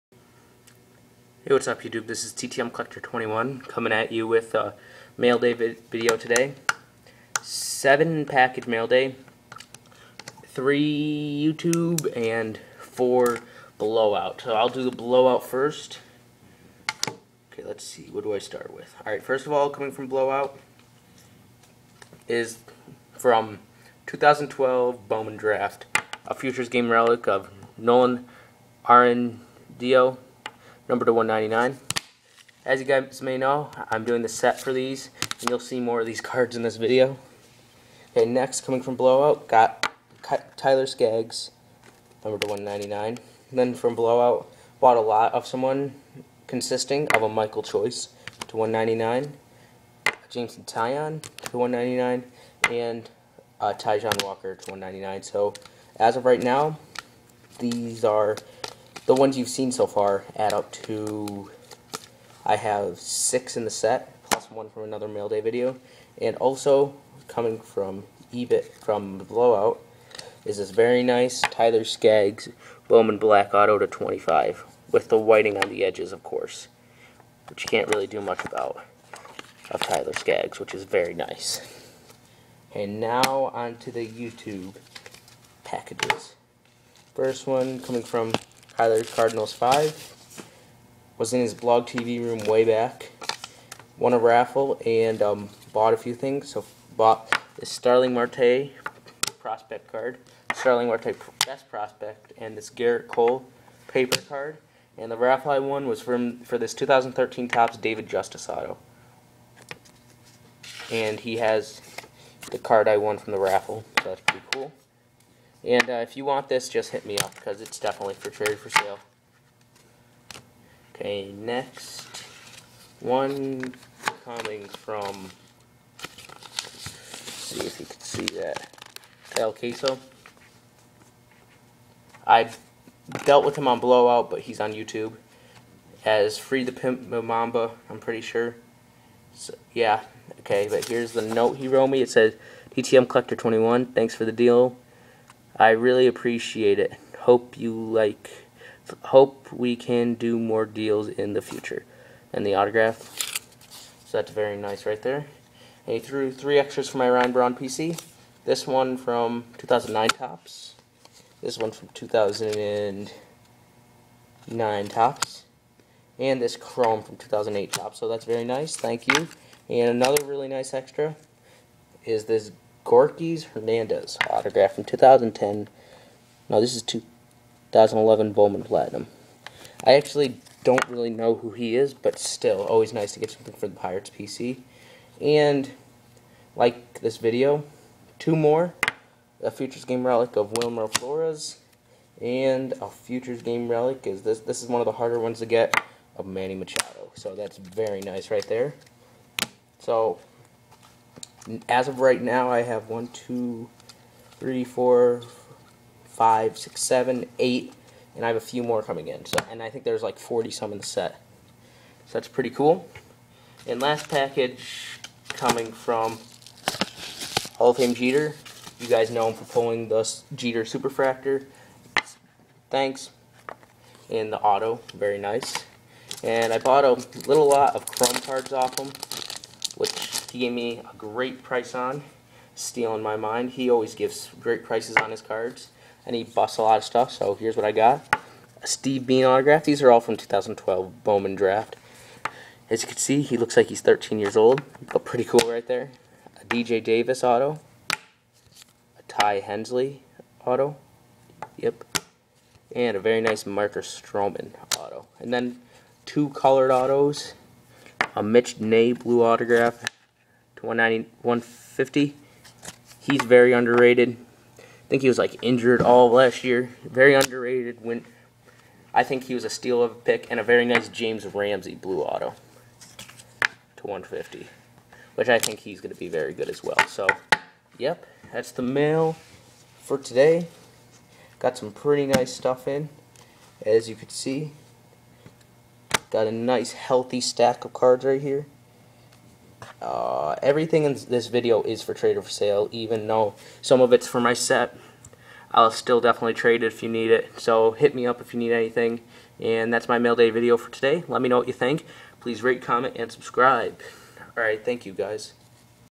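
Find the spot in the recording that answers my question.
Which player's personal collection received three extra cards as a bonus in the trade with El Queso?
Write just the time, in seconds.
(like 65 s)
157 s.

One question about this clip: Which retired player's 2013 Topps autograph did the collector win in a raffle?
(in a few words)
David Justice.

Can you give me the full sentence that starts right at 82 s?
And now onto the YouTube packages.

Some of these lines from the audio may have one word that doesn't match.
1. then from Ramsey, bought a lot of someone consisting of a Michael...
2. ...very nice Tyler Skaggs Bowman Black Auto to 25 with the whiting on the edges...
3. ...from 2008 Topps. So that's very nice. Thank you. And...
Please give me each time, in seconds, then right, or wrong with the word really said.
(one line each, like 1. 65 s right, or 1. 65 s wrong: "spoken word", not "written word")
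1. 43 s wrong: "Blowout", not "Ramsey"
2. 70 s right
3. 167 s right.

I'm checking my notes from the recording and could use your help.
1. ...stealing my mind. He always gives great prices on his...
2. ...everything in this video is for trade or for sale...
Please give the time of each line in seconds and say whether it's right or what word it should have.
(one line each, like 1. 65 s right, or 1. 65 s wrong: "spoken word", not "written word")
1. 232 s right
2. 290 s right.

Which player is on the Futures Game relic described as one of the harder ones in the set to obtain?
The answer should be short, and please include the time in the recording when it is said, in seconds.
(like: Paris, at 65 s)
Manny Machado, at 196 s.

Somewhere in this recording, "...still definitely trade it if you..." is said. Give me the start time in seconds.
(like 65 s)
295 s.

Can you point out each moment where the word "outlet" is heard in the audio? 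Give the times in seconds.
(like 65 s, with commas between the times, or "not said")
not said.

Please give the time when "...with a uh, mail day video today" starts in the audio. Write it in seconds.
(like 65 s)
4 s.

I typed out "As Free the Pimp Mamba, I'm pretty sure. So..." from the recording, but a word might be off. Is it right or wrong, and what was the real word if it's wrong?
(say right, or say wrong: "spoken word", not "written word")
right.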